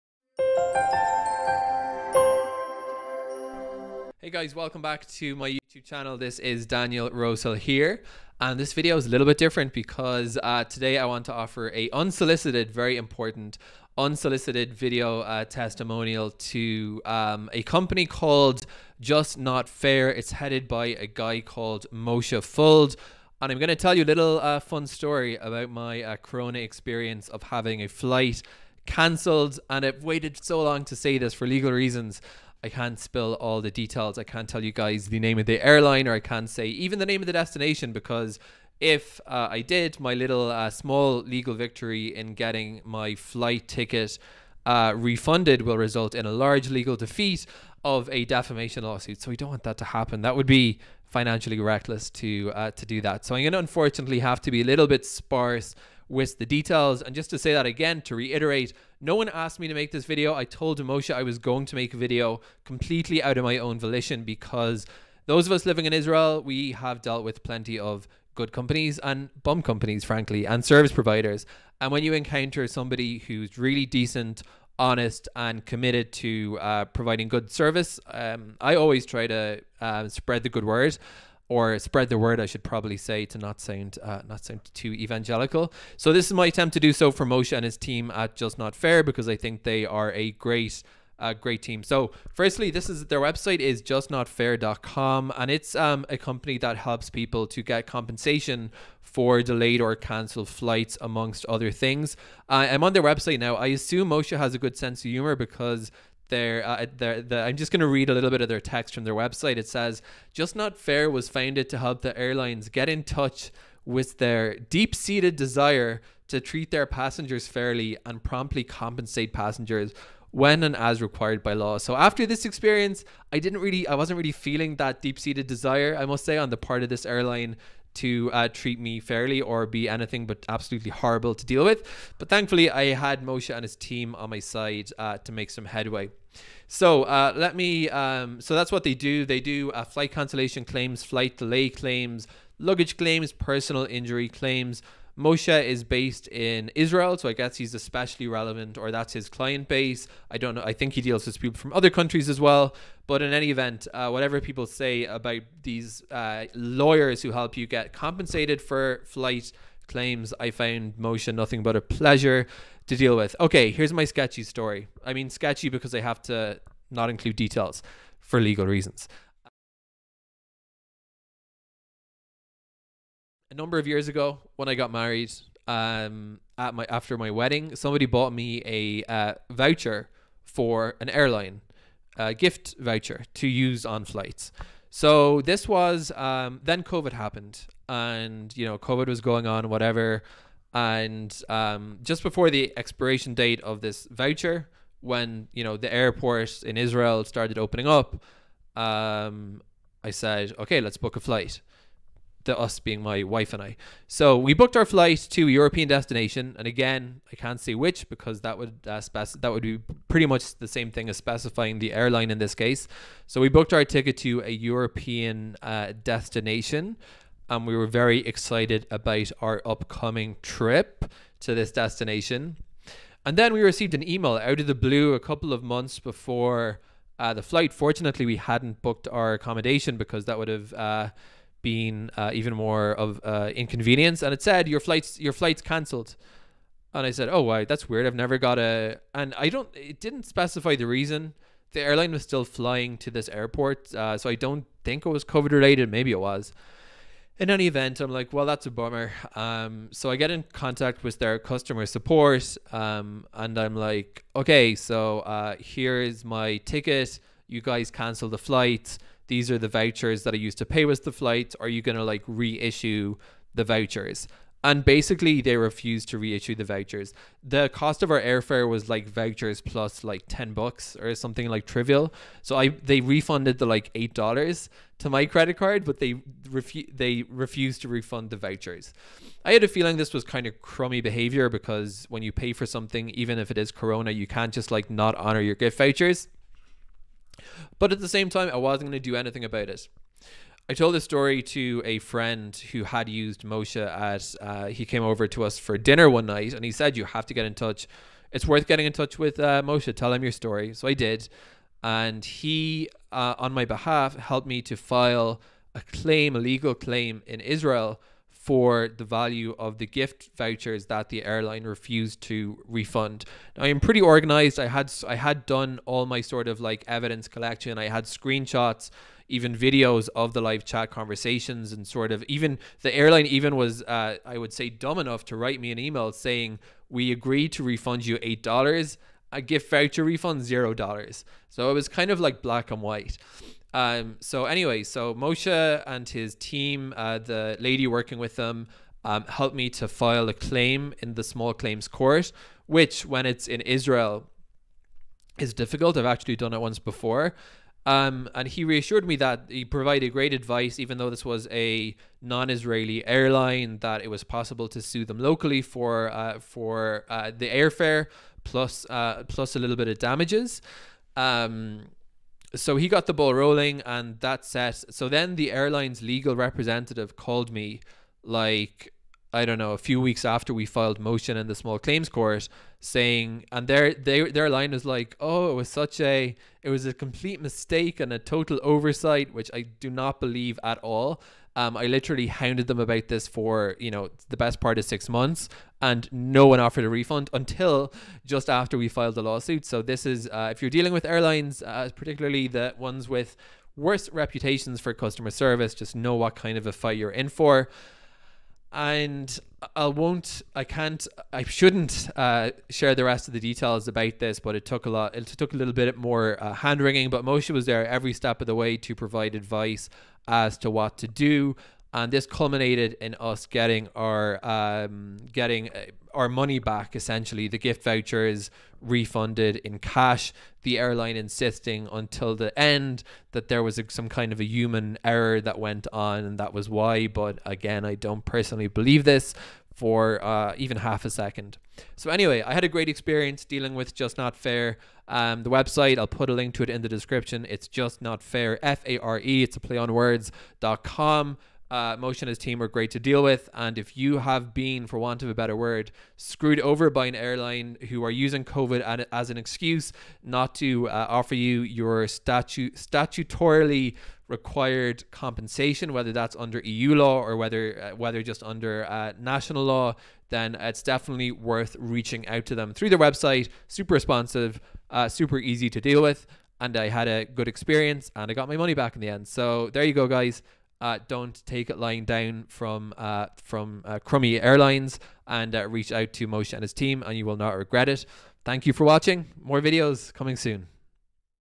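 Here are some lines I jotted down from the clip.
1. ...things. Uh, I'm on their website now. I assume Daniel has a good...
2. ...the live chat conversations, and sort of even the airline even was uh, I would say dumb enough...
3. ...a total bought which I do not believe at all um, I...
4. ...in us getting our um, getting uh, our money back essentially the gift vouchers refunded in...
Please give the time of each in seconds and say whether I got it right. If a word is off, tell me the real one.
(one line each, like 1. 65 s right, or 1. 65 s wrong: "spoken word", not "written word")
1. 101 s wrong: "Moshe", not "Daniel"
2. 320 s right
3. 378 s wrong: "oversight", not "bought"
4. 413 s right.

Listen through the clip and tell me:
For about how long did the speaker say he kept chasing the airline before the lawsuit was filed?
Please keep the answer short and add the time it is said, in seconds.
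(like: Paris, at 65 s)
six months, at 384 s.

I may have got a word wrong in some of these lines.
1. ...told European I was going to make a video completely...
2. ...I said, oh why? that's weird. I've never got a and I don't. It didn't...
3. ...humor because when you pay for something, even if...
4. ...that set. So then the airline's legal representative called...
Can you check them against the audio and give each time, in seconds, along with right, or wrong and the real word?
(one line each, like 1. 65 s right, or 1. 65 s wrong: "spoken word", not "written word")
1. 60 s wrong: "Moshe", not "European"
2. 237 s right
3. 281 s wrong: "behavior", not "humor"
4. 364 s right.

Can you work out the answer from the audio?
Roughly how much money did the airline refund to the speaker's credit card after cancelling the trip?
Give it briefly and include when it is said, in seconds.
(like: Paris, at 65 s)
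$8, at 273 s.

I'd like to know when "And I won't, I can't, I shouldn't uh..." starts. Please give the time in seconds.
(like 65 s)
398 s.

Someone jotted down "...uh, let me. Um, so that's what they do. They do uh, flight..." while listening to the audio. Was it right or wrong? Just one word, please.
right.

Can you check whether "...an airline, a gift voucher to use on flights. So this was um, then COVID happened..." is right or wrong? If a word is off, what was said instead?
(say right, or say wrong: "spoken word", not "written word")
right.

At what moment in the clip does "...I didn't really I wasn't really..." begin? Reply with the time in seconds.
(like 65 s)
123 s.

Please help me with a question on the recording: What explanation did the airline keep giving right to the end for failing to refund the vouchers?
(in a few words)
human error.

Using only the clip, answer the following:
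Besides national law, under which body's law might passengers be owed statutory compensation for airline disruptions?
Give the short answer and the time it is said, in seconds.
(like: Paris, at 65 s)
EU law, at 456 s.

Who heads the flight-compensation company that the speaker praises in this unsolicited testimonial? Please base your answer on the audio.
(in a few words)
Moshe Fuld.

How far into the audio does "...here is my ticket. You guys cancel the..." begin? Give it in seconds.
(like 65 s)
255 s.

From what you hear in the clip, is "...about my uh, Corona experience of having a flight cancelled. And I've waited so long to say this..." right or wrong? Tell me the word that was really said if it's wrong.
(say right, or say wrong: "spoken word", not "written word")
right.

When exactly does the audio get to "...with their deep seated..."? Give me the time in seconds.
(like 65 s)
113 s.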